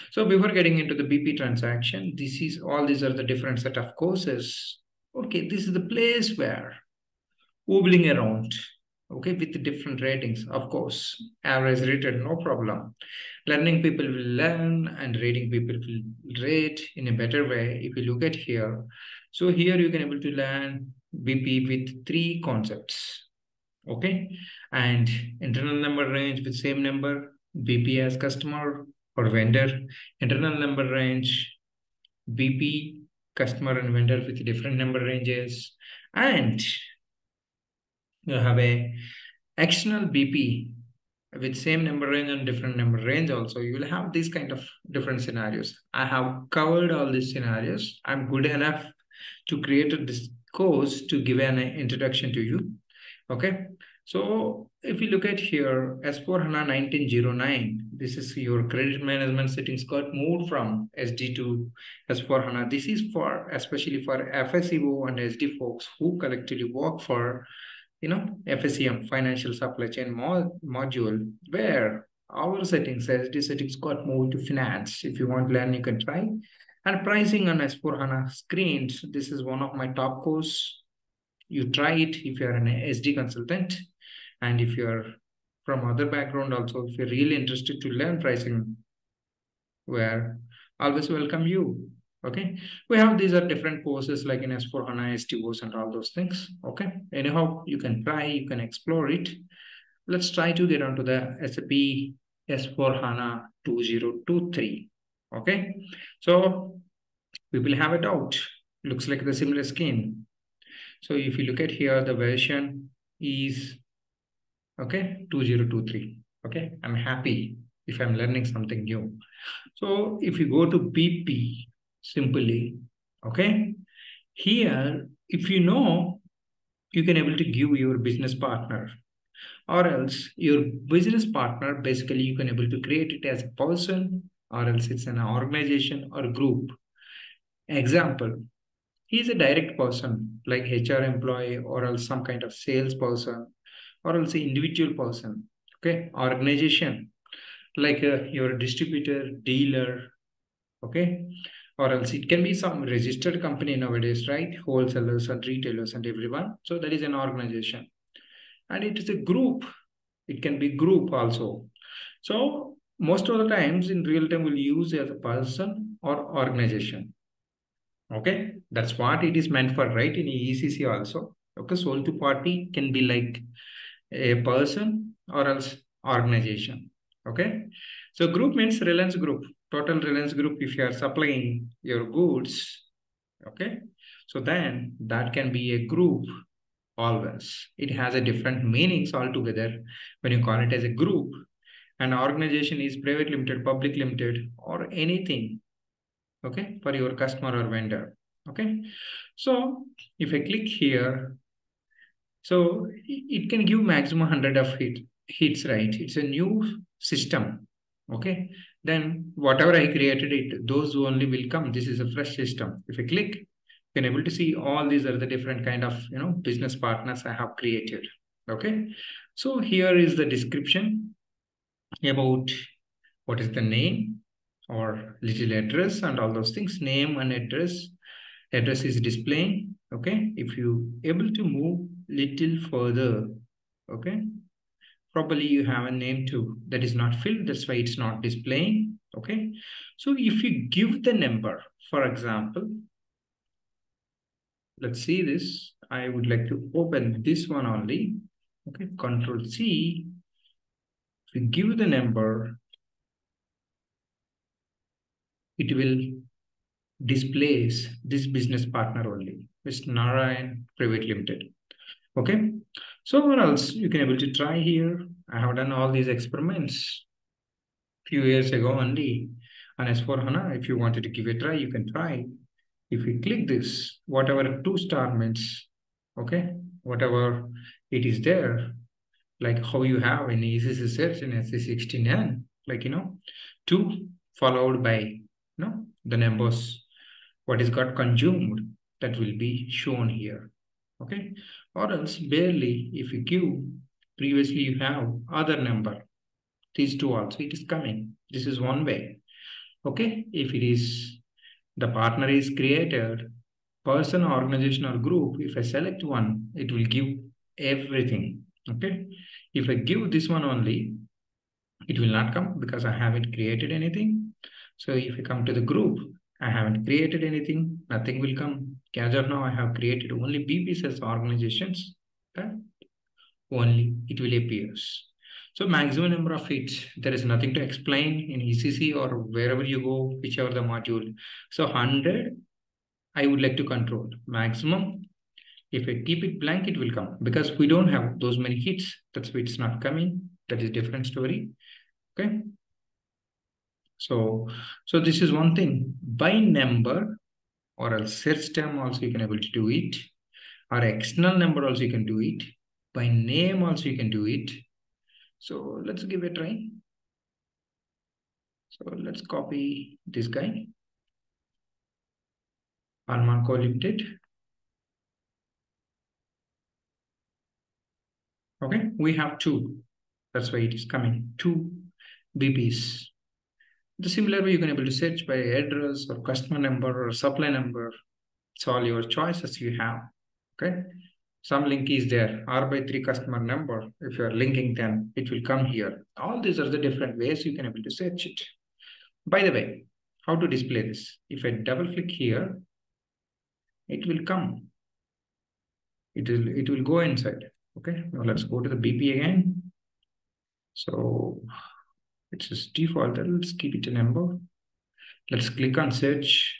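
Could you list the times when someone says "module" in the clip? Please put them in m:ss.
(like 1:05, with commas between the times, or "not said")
1:10, 5:30.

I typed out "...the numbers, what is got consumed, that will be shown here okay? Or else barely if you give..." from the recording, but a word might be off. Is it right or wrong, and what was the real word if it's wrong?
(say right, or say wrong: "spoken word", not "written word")
right.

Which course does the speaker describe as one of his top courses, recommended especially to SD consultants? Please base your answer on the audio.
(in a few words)
Pricing on S4 HANA.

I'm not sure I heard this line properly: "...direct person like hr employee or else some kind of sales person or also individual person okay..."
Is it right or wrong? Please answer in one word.
right.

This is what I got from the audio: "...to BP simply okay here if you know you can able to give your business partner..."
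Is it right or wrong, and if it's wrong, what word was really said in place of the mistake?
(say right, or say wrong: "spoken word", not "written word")
right.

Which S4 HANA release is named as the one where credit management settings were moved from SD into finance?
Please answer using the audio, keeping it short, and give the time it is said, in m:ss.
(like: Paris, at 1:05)
1909, at 0:56.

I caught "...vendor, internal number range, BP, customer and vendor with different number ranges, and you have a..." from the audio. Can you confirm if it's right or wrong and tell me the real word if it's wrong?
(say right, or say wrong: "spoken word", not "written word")
right.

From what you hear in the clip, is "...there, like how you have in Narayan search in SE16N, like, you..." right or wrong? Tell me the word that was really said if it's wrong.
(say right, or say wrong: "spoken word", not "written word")
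wrong: "ECC", not "Narayan".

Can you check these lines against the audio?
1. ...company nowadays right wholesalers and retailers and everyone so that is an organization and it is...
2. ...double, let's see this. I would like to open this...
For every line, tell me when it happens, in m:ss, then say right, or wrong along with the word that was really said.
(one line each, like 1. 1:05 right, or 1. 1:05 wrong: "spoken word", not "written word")
1. 2:33 right
2. 4:02 wrong: "example", not "double".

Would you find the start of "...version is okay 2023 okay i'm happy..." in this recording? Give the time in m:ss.
1:52.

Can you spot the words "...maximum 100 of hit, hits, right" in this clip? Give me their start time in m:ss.
3:23.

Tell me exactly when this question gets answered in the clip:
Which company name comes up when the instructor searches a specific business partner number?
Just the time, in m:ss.
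4:19.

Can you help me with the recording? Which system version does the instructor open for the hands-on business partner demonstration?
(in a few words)
SAP S4 HANA 2023.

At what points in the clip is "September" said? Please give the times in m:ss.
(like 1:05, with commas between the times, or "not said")
not said.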